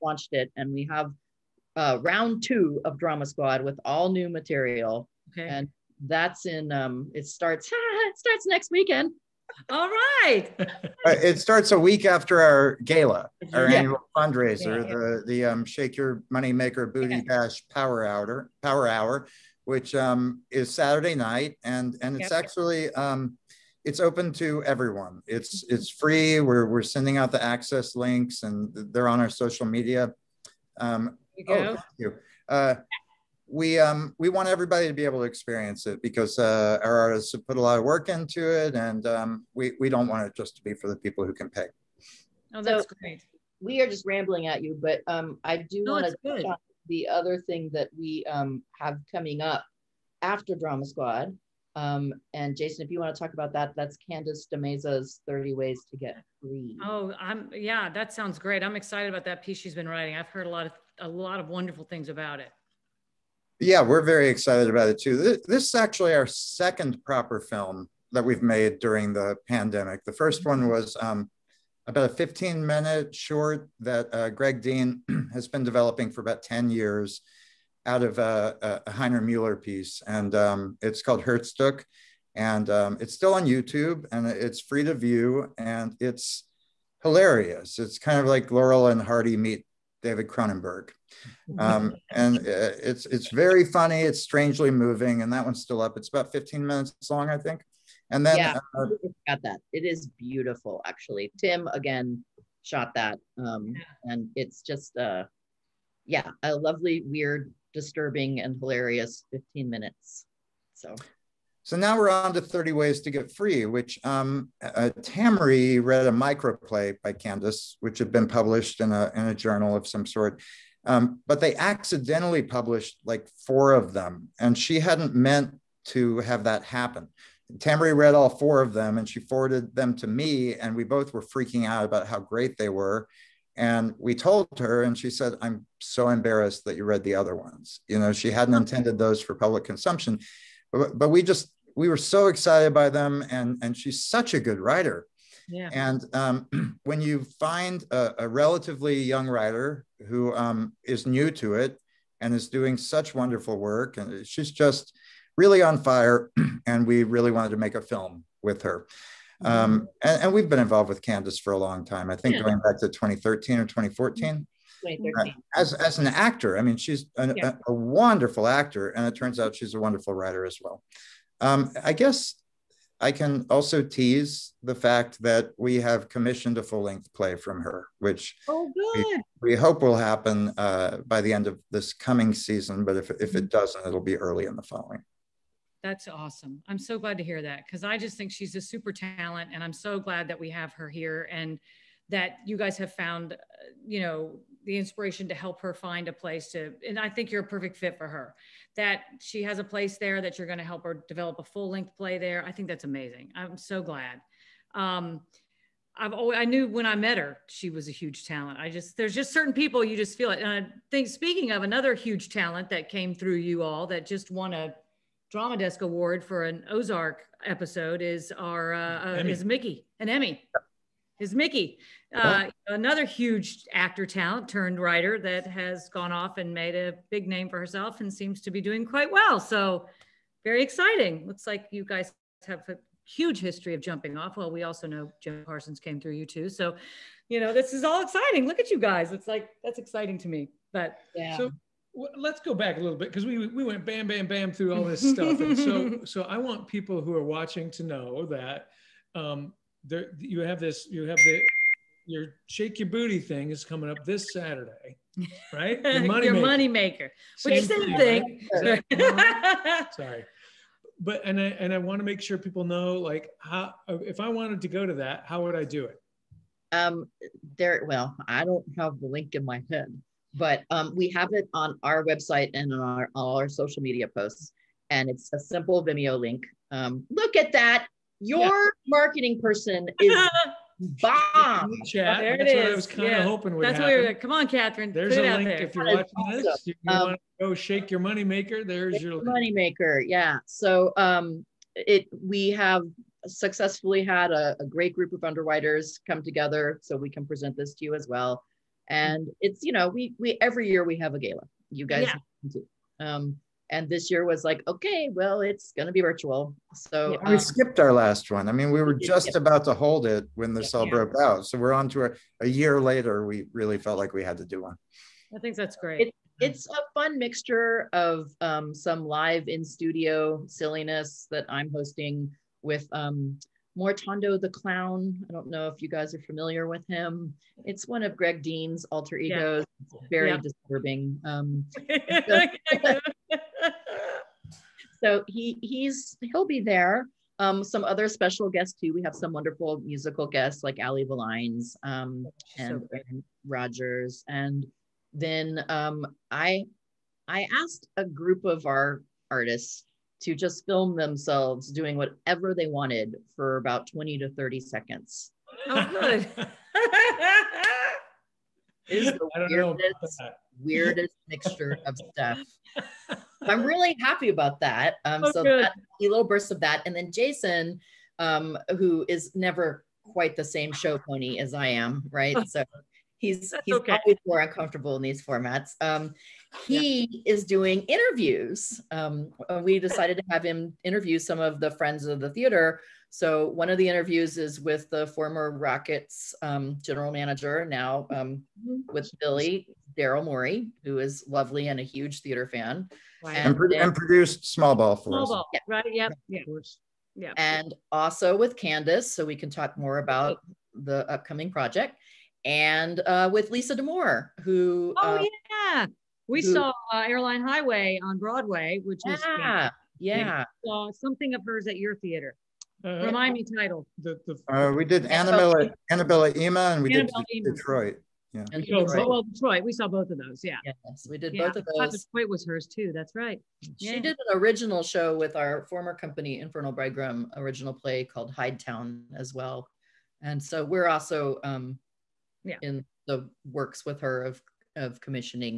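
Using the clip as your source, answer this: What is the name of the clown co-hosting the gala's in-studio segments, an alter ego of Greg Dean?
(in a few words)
Mortondo the Clown.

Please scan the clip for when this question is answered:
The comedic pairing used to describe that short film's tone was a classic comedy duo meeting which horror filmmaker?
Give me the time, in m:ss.
1:30.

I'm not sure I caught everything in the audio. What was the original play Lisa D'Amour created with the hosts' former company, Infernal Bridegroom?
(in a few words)
Town.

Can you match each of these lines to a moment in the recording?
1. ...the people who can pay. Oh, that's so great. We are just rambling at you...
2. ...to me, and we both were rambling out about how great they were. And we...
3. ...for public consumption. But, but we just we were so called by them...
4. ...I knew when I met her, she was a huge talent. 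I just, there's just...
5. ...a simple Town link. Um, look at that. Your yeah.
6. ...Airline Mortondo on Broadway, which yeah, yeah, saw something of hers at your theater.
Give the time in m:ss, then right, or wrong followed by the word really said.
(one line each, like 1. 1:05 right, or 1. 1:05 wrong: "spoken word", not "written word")
1. 0:40 right
2. 2:09 wrong: "freaking", not "rambling"
3. 2:19 wrong: "excited", not "called"
4. 3:26 right
5. 4:35 wrong: "Vimeo", not "Town"
6. 6:47 wrong: "Highway", not "Mortondo".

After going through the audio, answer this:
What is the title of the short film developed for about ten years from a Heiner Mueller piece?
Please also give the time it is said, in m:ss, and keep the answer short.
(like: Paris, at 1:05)
Herzstück, at 1:21.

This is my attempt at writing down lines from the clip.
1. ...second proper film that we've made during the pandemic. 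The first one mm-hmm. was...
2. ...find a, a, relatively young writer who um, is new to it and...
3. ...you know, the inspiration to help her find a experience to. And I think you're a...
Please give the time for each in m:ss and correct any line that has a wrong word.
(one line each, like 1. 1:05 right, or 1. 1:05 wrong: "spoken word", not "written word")
1. 1:06 right
2. 2:27 right
3. 3:13 wrong: "place", not "experience".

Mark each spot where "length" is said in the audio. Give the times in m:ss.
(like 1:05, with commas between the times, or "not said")
2:56, 3:21.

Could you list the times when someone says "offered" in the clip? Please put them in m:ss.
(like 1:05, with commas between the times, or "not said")
not said.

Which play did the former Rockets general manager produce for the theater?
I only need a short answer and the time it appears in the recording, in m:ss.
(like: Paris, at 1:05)
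Small Ball, at 6:34.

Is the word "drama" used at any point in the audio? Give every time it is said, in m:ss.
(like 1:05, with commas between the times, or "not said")
0:02, 0:50, 3:35.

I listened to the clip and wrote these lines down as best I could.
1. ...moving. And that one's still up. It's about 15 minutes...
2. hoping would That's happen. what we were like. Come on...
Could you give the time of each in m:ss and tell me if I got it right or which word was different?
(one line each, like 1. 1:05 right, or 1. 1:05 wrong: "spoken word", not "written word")
1. 1:34 right
2. 4:43 right.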